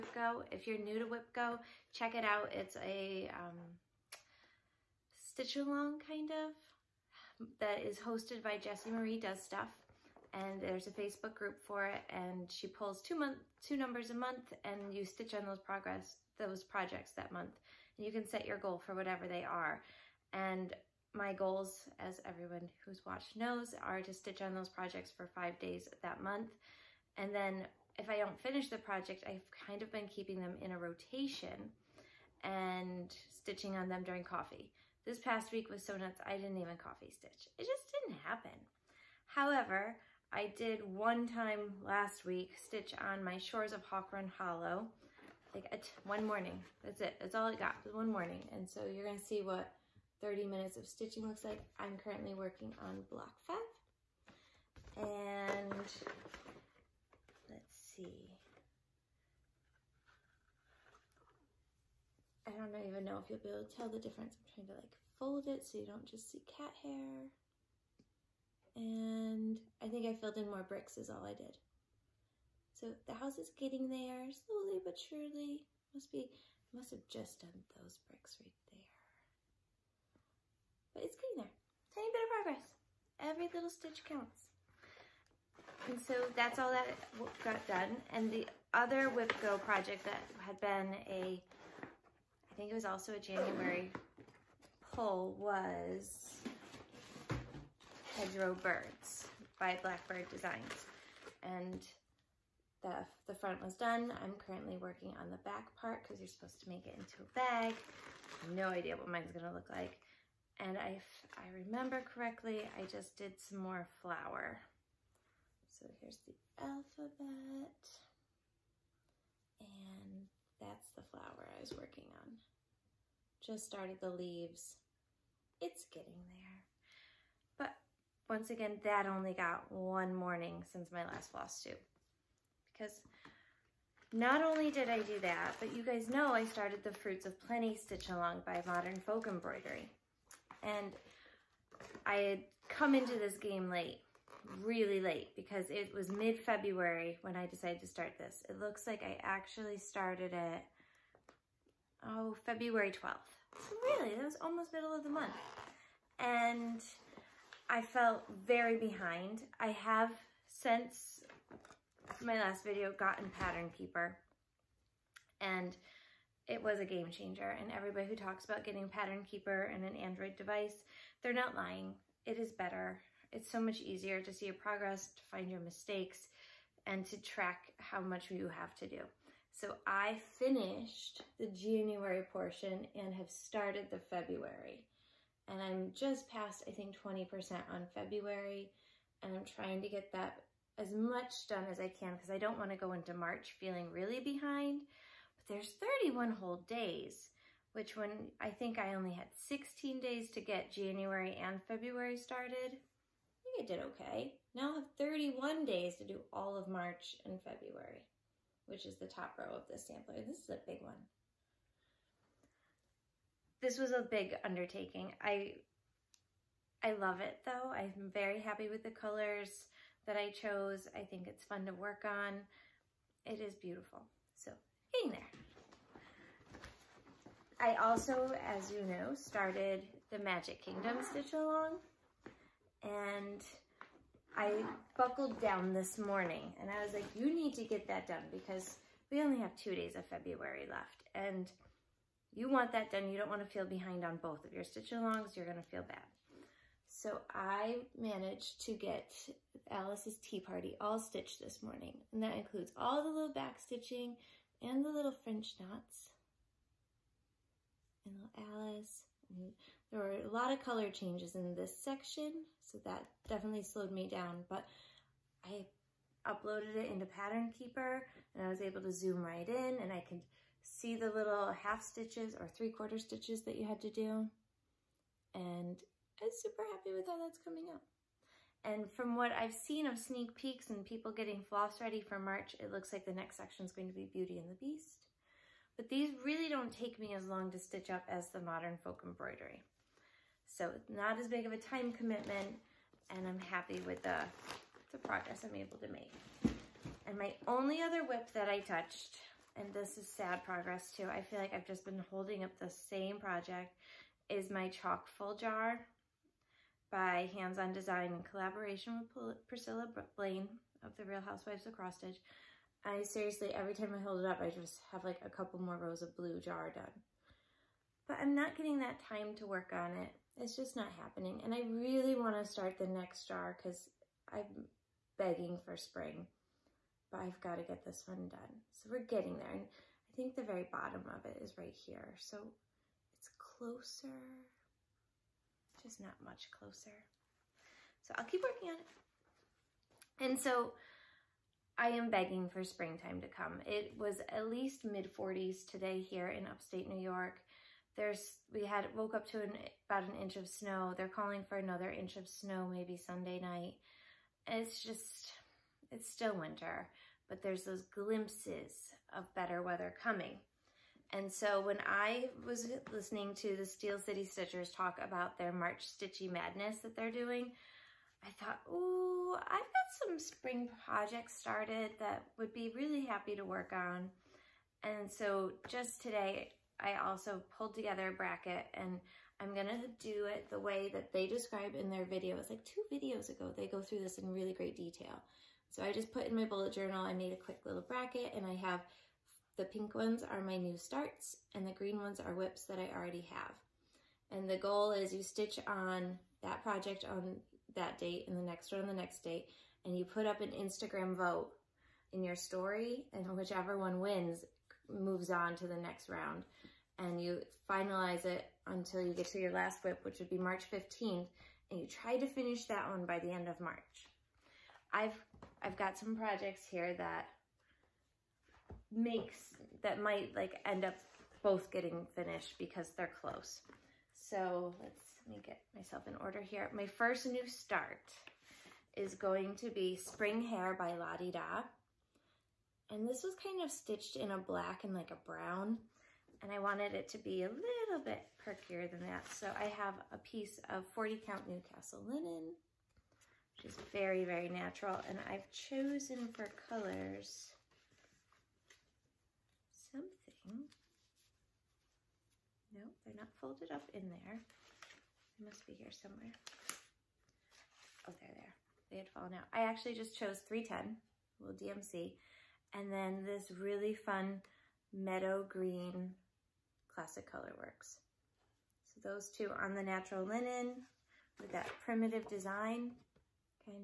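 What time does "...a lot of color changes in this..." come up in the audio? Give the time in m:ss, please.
4:20.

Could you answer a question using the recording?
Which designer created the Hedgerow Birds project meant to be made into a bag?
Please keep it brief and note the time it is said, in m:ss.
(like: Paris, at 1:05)
Blackbird Designs, at 1:39.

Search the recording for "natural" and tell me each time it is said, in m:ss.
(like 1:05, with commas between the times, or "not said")
7:24, 7:49.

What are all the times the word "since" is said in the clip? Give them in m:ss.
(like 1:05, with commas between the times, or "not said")
2:10, 2:40.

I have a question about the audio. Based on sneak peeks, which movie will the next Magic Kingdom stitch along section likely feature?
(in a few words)
Beauty and the Beast.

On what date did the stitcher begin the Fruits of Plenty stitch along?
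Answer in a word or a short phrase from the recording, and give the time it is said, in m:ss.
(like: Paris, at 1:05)
February 12th, at 2:32.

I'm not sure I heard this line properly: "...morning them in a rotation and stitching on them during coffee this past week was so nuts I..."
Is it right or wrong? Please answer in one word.
wrong.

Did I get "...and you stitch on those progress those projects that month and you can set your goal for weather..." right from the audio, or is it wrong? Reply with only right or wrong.
wrong.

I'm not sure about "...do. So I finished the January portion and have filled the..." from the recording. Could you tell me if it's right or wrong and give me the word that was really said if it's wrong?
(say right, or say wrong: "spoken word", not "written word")
wrong: "started", not "filled".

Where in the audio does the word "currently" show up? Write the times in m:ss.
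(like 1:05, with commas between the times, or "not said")
0:52, 1:44.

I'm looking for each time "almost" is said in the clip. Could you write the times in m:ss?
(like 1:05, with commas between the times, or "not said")
2:34.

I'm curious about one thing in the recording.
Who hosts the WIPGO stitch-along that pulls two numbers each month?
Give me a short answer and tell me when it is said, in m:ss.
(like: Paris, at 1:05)
Jessie Marie Does Stuff, at 0:08.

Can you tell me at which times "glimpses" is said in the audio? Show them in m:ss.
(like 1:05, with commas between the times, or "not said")
5:57.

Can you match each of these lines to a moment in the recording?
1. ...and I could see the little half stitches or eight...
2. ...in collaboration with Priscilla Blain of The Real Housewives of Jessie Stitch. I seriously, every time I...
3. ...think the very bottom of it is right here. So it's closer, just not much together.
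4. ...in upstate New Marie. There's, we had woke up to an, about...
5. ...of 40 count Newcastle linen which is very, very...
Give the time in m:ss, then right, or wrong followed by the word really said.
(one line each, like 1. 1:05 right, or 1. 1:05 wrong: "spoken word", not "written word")
1. 4:29 wrong: "three", not "eight"
2. 5:08 wrong: "Cross", not "Jessie"
3. 5:30 wrong: "closer", not "together"
4. 5:46 wrong: "York", not "Marie"
5. 7:20 right.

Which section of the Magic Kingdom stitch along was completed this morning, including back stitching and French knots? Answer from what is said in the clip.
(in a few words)
Alice's tea party.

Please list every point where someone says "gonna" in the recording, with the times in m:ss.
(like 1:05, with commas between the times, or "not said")
1:49, 6:19.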